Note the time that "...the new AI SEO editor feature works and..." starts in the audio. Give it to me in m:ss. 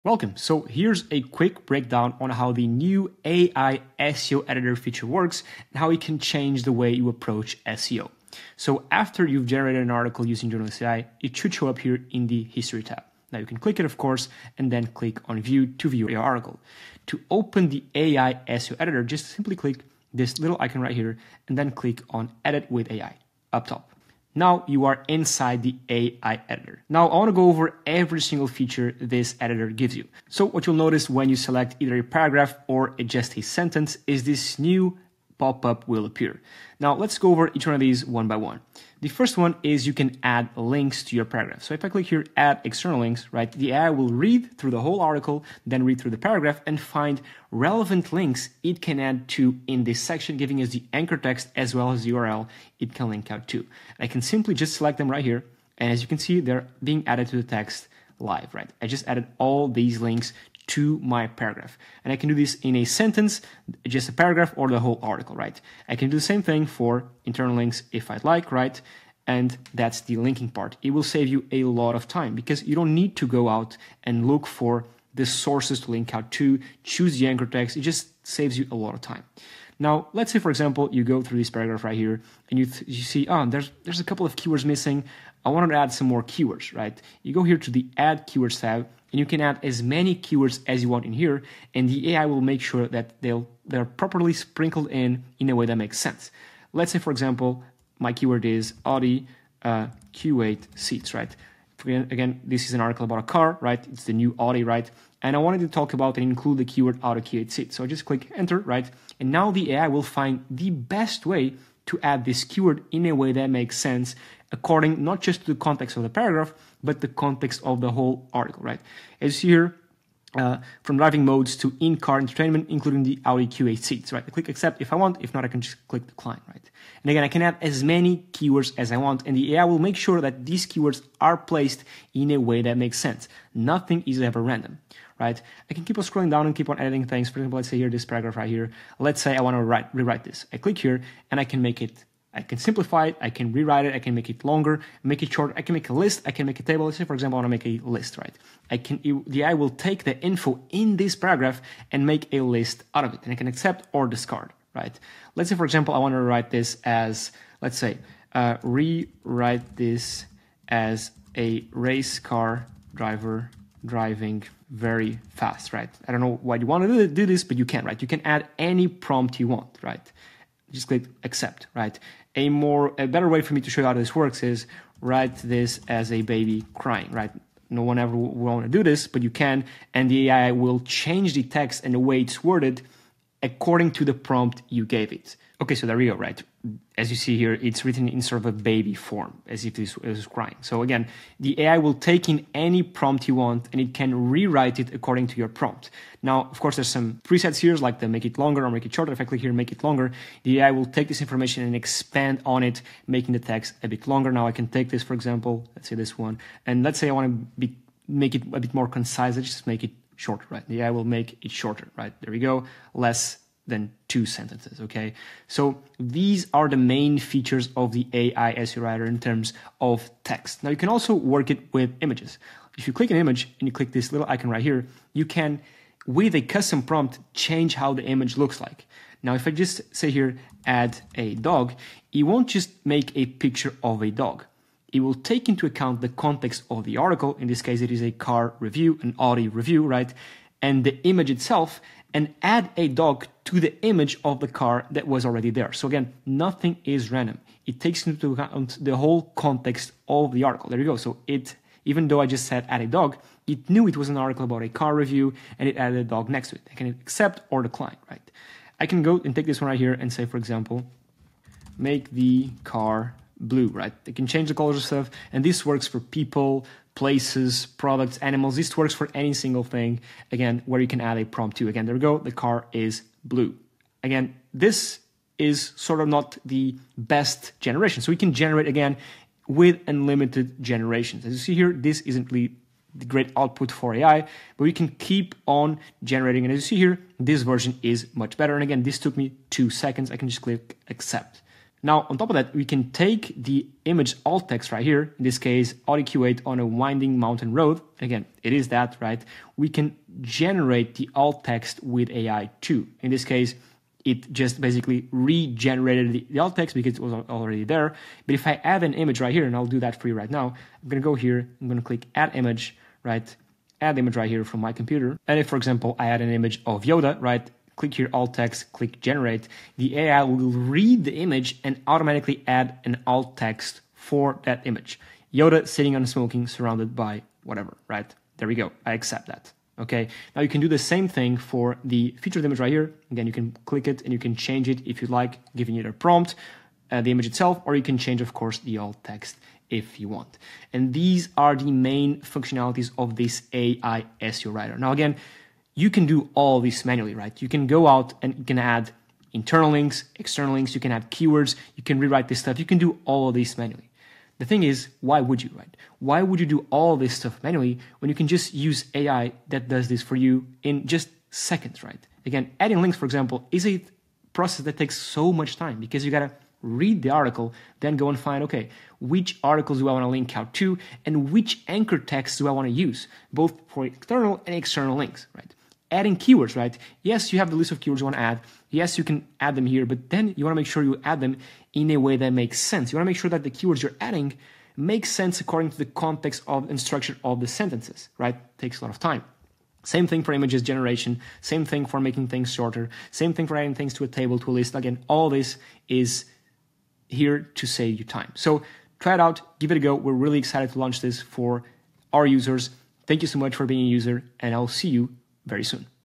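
0:02.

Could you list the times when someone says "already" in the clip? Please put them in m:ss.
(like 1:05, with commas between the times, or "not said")
4:05, 5:07.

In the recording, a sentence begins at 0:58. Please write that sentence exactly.
I just added all these links to my paragraph.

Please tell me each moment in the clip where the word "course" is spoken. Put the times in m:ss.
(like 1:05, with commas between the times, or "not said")
0:13, 3:16, 5:38.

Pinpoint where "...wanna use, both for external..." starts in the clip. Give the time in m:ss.
6:12.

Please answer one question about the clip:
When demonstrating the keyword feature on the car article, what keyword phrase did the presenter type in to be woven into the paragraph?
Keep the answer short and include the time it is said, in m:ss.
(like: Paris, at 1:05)
Audi Q8 seats, at 1:38.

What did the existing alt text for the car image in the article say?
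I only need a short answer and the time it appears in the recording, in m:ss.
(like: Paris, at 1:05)
RS Q8 on a winding mountain road, at 4:55.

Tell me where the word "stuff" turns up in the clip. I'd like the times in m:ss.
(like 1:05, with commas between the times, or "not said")
4:24, 5:52, 5:57.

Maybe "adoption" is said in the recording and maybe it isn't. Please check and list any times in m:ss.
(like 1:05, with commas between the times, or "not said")
not said.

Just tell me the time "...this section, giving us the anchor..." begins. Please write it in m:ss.
0:49.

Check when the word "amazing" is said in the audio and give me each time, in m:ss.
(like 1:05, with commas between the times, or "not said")
not said.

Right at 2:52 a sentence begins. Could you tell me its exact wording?
A more, a better way for me to show you how this works is write this as a baby crying, right?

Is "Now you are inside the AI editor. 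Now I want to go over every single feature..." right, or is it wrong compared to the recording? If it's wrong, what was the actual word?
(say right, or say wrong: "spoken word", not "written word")
right.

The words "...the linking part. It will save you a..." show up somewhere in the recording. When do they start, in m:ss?
1:10.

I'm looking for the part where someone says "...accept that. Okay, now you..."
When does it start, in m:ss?
5:28.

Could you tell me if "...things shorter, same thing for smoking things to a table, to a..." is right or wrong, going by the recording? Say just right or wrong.
wrong.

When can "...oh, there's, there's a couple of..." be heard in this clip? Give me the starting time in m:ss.
1:23.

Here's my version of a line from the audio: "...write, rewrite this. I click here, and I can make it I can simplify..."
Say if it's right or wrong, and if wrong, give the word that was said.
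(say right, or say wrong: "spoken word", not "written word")
right.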